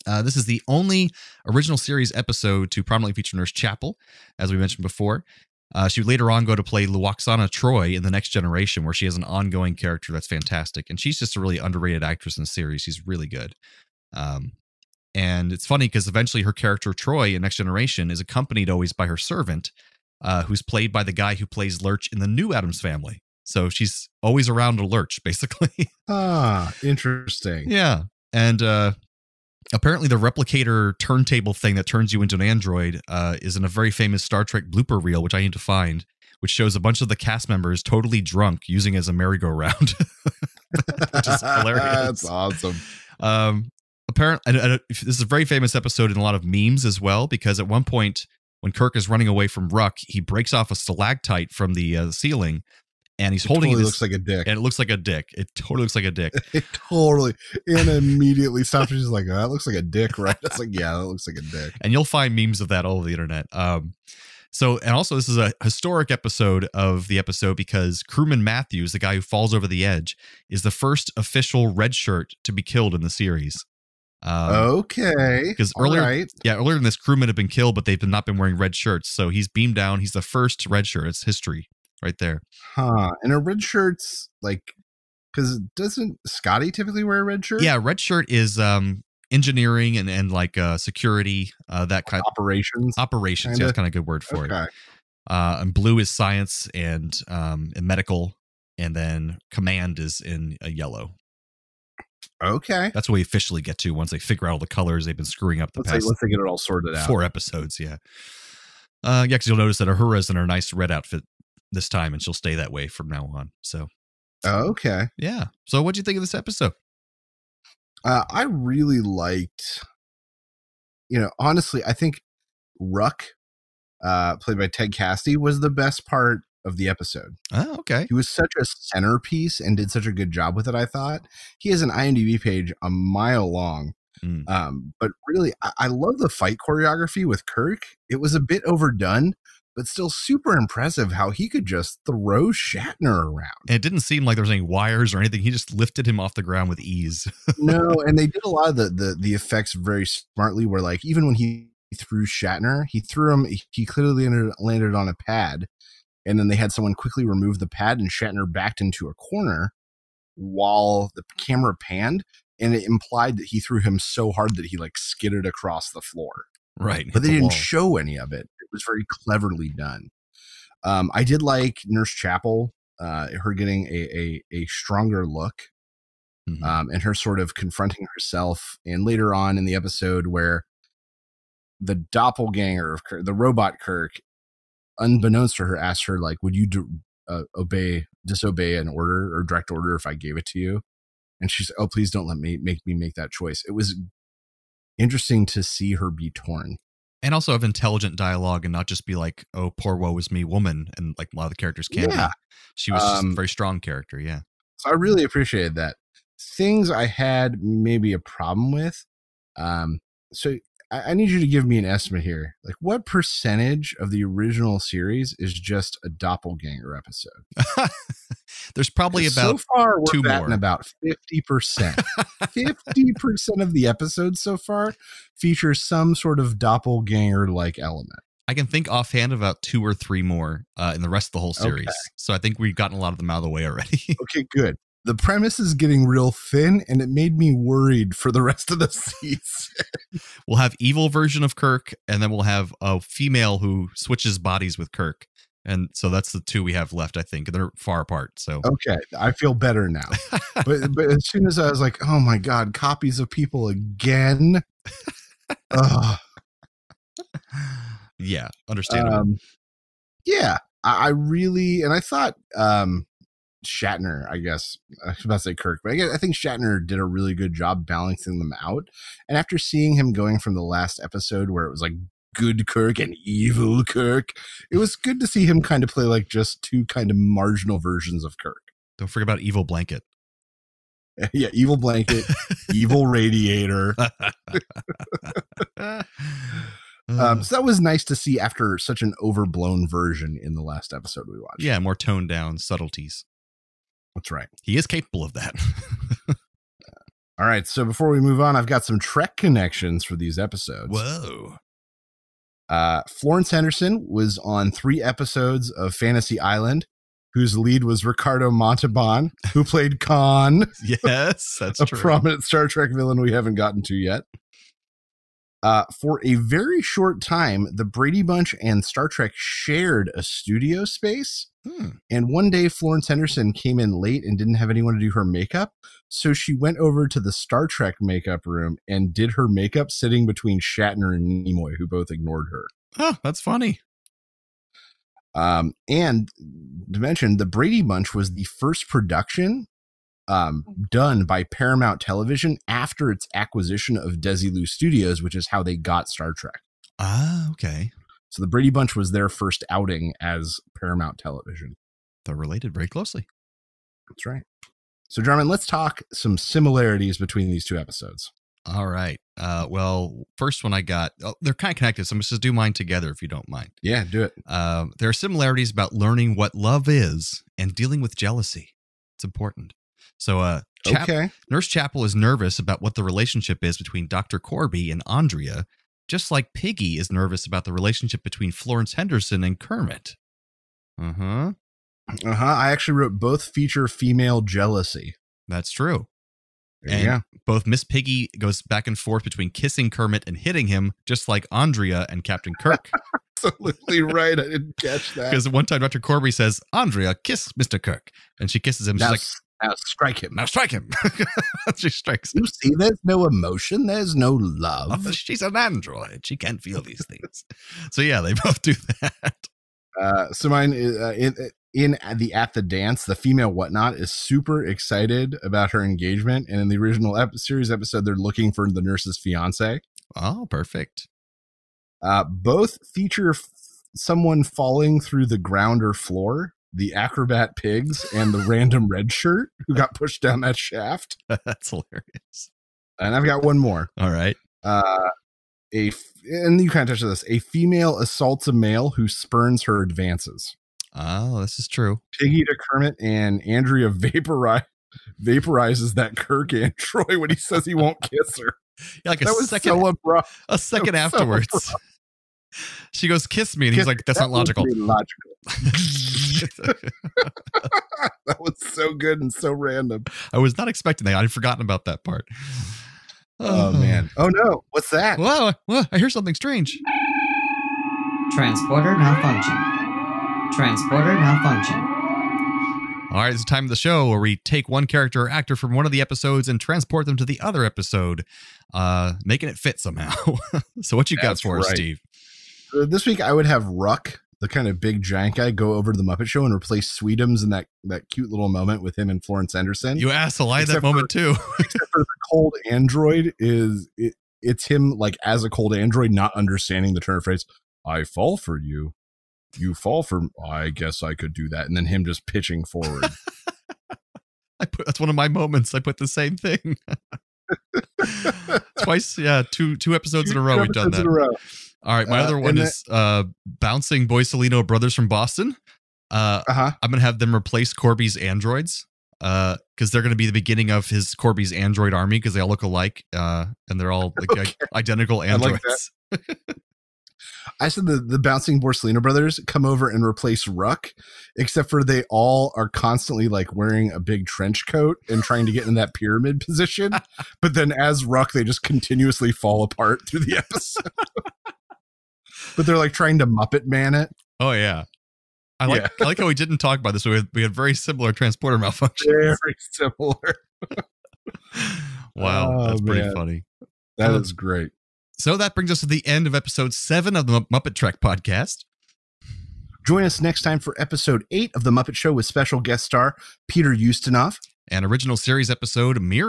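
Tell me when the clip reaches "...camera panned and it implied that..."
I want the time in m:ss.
2:41.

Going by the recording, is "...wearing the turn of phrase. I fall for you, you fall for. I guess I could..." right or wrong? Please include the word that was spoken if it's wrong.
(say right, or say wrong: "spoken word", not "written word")
wrong: "understanding", not "wearing".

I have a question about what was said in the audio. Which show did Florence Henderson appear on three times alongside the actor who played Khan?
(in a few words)
Fantasy Island.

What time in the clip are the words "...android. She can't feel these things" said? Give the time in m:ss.
6:45.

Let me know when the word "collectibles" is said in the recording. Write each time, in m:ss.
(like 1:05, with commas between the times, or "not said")
not said.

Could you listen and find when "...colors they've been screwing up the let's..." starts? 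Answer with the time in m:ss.
1:44.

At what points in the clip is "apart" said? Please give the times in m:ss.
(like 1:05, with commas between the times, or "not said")
4:08, 8:59.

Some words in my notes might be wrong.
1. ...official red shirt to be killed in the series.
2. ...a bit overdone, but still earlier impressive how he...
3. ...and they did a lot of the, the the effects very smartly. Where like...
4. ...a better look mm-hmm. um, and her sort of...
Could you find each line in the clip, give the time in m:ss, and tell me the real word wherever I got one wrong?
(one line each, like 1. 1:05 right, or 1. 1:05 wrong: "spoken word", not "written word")
1. 1:11 right
2. 2:18 wrong: "super", not "earlier"
3. 2:28 right
4. 2:54 wrong: "stronger", not "better".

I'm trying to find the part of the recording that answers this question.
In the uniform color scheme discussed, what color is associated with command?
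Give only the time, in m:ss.
1:40.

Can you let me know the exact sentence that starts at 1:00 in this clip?
It's like, yeah, that looks like a dick.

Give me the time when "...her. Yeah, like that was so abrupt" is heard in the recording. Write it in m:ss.
7:28.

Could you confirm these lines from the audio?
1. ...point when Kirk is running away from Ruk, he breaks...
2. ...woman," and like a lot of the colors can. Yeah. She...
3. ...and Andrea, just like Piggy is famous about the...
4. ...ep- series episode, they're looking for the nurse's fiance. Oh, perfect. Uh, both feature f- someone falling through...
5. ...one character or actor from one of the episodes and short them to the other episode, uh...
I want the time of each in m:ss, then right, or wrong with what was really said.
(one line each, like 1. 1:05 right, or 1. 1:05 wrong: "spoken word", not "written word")
1. 0:47 right
2. 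3:20 wrong: "characters", not "colors"
3. 6:14 wrong: "nervous", not "famous"
4. 6:57 right
5. 7:54 wrong: "transport", not "short".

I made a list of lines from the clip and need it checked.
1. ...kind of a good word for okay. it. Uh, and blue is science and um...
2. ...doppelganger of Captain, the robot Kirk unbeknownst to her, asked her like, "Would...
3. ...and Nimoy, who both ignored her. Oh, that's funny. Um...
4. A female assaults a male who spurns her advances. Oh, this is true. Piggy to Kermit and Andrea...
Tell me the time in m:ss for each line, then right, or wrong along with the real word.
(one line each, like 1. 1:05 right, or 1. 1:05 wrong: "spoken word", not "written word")
1. 1:33 right
2. 3:01 wrong: "Kirk", not "Captain"
3. 5:31 right
4. 7:17 right.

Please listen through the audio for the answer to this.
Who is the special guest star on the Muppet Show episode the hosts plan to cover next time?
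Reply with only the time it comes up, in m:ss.
9:23.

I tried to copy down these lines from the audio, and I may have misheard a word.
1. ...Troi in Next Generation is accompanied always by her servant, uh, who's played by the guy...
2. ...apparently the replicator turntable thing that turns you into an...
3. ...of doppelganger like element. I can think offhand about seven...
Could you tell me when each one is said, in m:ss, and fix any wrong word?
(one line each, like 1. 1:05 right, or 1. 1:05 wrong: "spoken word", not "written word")
1. 0:16 right
2. 0:29 right
3. 3:46 wrong: "two", not "seven".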